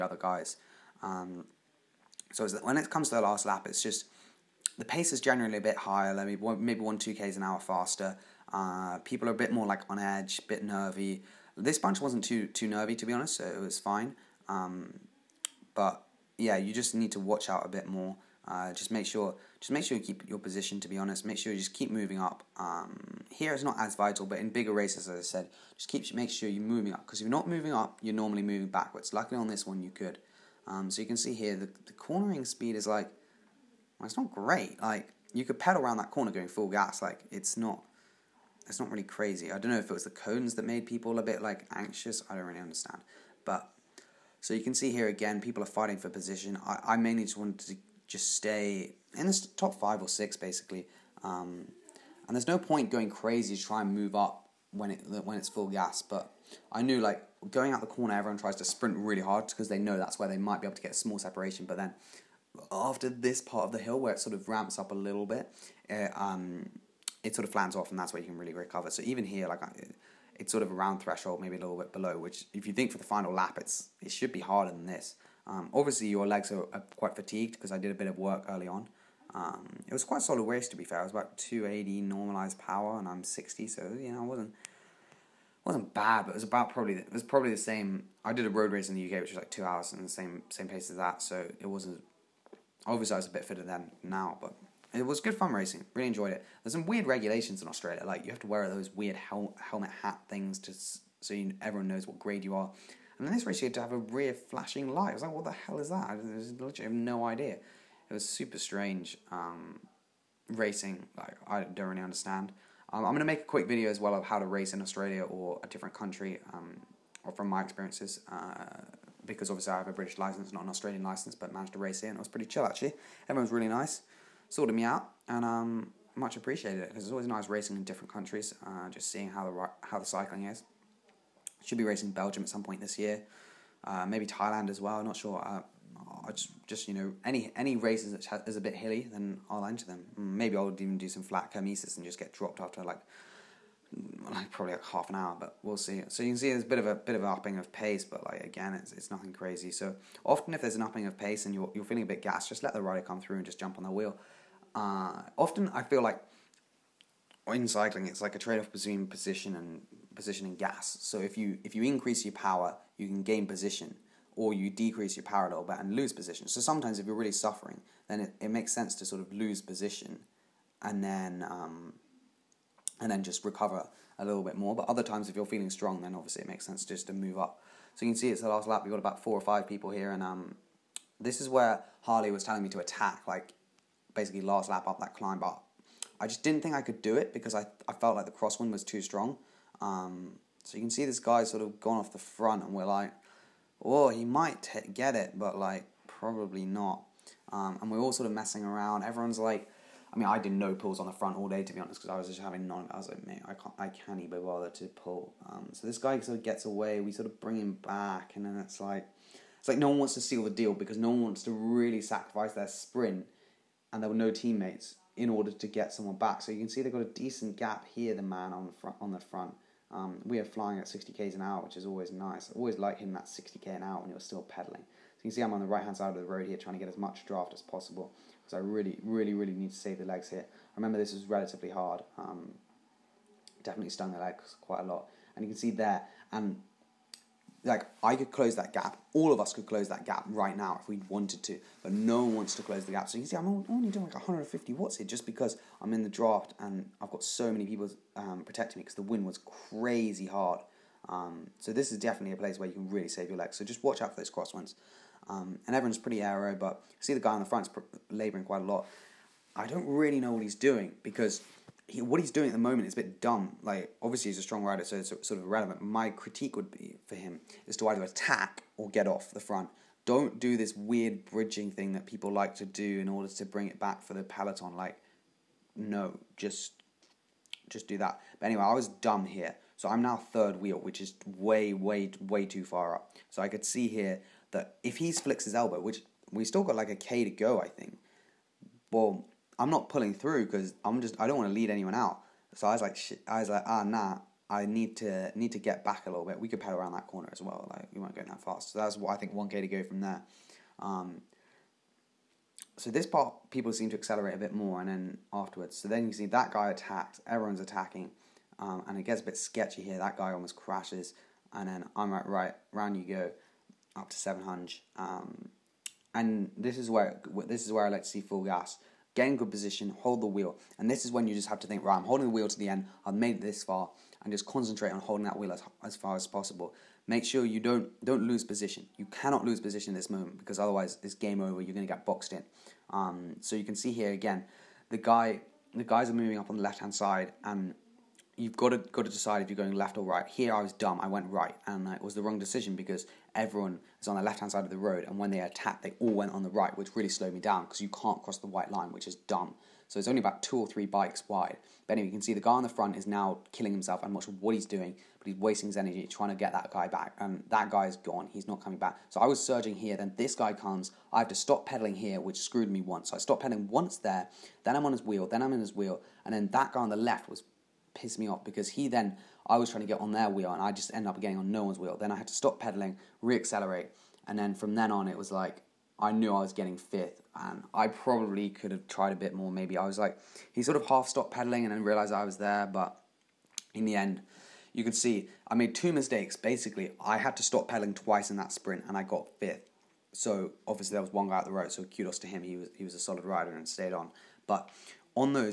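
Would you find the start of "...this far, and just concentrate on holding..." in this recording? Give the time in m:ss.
5:23.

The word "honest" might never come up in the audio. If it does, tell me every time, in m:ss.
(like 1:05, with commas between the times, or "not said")
0:13, 0:20, 3:21.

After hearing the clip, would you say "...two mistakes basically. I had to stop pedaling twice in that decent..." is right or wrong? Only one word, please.
wrong.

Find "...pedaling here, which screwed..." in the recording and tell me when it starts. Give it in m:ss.
6:01.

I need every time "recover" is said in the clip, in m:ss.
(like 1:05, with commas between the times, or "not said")
1:08, 2:53.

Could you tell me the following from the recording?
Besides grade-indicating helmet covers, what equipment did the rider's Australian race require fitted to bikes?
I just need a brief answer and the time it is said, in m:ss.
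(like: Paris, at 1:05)
Rear flashing light, at 1:43.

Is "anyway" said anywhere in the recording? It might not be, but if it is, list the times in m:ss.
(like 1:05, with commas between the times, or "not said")
4:38, 5:51.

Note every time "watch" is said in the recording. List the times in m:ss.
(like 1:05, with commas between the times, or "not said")
0:17, 4:13.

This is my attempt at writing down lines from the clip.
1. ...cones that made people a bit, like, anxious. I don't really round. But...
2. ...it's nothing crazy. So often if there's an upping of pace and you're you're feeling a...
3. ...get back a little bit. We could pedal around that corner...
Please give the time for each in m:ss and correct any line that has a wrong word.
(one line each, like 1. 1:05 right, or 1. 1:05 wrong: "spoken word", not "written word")
1. 0:40 wrong: "understand", not "round"
2. 2:28 right
3. 4:55 right.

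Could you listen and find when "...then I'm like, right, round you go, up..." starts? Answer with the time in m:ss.
5:11.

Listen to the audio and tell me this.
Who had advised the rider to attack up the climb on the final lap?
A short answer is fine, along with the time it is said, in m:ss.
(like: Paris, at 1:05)
Harley, at 3:02.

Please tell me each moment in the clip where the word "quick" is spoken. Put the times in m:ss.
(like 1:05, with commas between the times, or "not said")
1:53.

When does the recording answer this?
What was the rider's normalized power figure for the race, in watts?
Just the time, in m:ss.
1:21.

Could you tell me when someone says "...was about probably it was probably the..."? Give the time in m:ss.
1:26.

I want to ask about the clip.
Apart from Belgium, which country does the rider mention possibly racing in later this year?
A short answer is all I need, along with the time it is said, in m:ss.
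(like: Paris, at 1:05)
Thailand, at 2:14.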